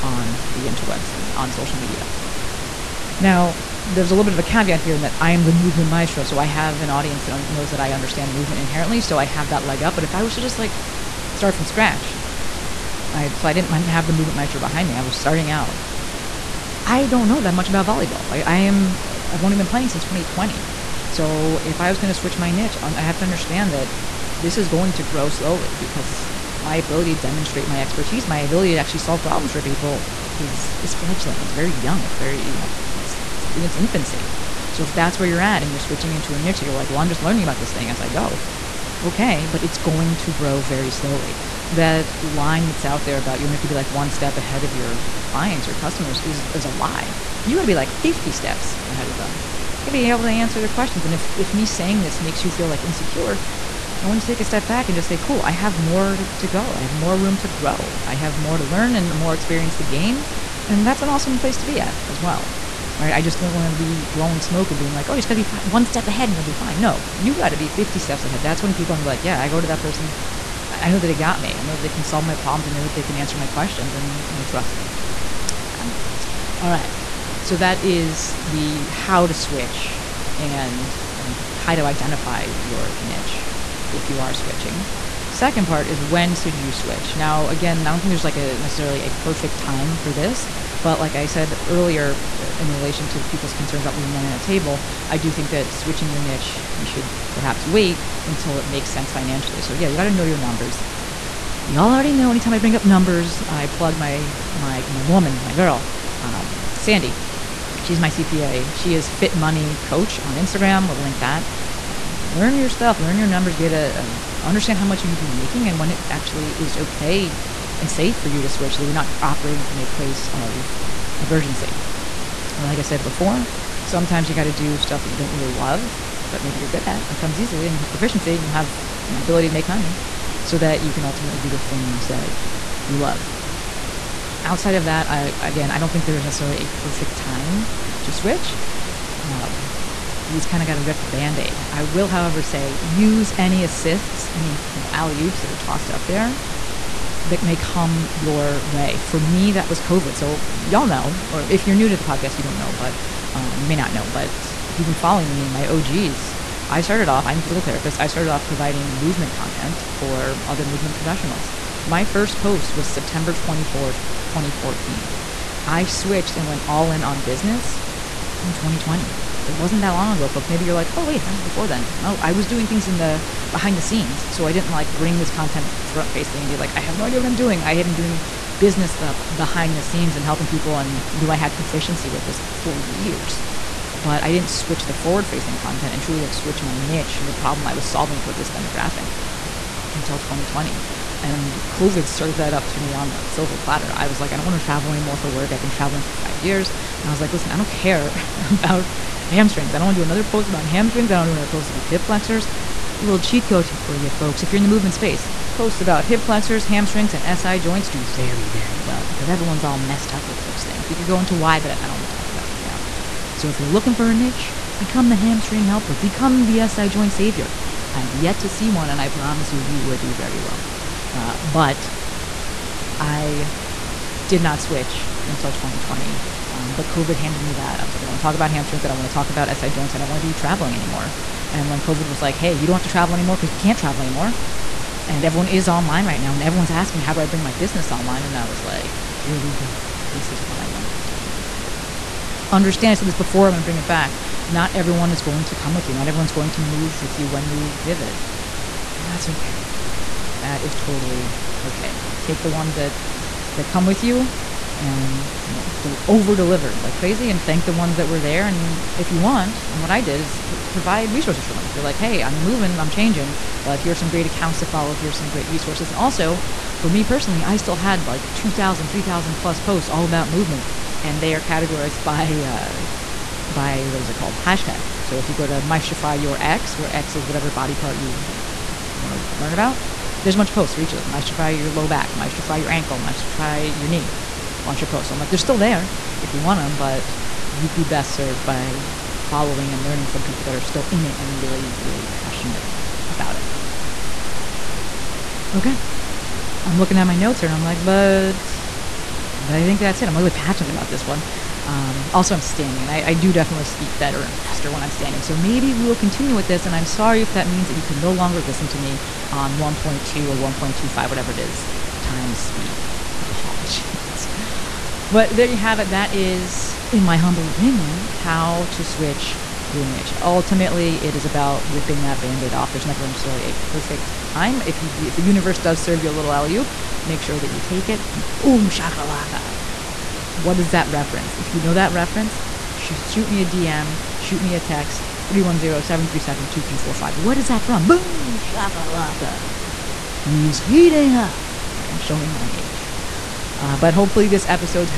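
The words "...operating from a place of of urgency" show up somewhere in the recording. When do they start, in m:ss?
1:59.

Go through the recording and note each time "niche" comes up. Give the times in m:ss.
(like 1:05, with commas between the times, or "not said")
0:22, 0:36, 1:22, 1:36, 3:06, 3:34, 5:19.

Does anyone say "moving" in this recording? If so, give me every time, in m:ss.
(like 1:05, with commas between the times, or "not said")
4:22.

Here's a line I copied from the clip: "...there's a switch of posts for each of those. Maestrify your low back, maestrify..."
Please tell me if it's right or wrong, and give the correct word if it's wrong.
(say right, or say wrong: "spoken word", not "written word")
wrong: "bunch", not "switch".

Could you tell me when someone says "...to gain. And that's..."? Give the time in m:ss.
0:59.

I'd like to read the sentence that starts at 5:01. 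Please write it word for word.
Um, also, I'm standing, and I, I, do definitely speak better and faster when I'm standing.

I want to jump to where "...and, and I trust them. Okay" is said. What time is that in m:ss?
1:13.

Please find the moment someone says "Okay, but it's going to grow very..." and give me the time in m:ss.
0:39.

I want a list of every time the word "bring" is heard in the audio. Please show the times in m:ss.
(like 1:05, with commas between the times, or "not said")
1:42, 2:54, 3:57, 4:03.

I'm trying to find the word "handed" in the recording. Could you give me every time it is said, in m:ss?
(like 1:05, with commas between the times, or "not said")
3:47.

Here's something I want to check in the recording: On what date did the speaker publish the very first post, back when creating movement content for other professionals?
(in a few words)
September 24th, 2014.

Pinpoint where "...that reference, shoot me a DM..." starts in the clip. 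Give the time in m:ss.
5:31.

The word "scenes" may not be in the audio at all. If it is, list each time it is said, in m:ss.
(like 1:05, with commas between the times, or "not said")
2:53, 2:59.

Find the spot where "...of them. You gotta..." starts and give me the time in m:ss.
0:49.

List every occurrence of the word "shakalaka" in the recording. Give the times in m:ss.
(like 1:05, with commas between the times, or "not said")
5:28, 5:38.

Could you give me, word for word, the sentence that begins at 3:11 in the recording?
And COVID served that up to me on a silver platter.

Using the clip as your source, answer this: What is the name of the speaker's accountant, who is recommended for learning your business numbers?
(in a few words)
Sandi.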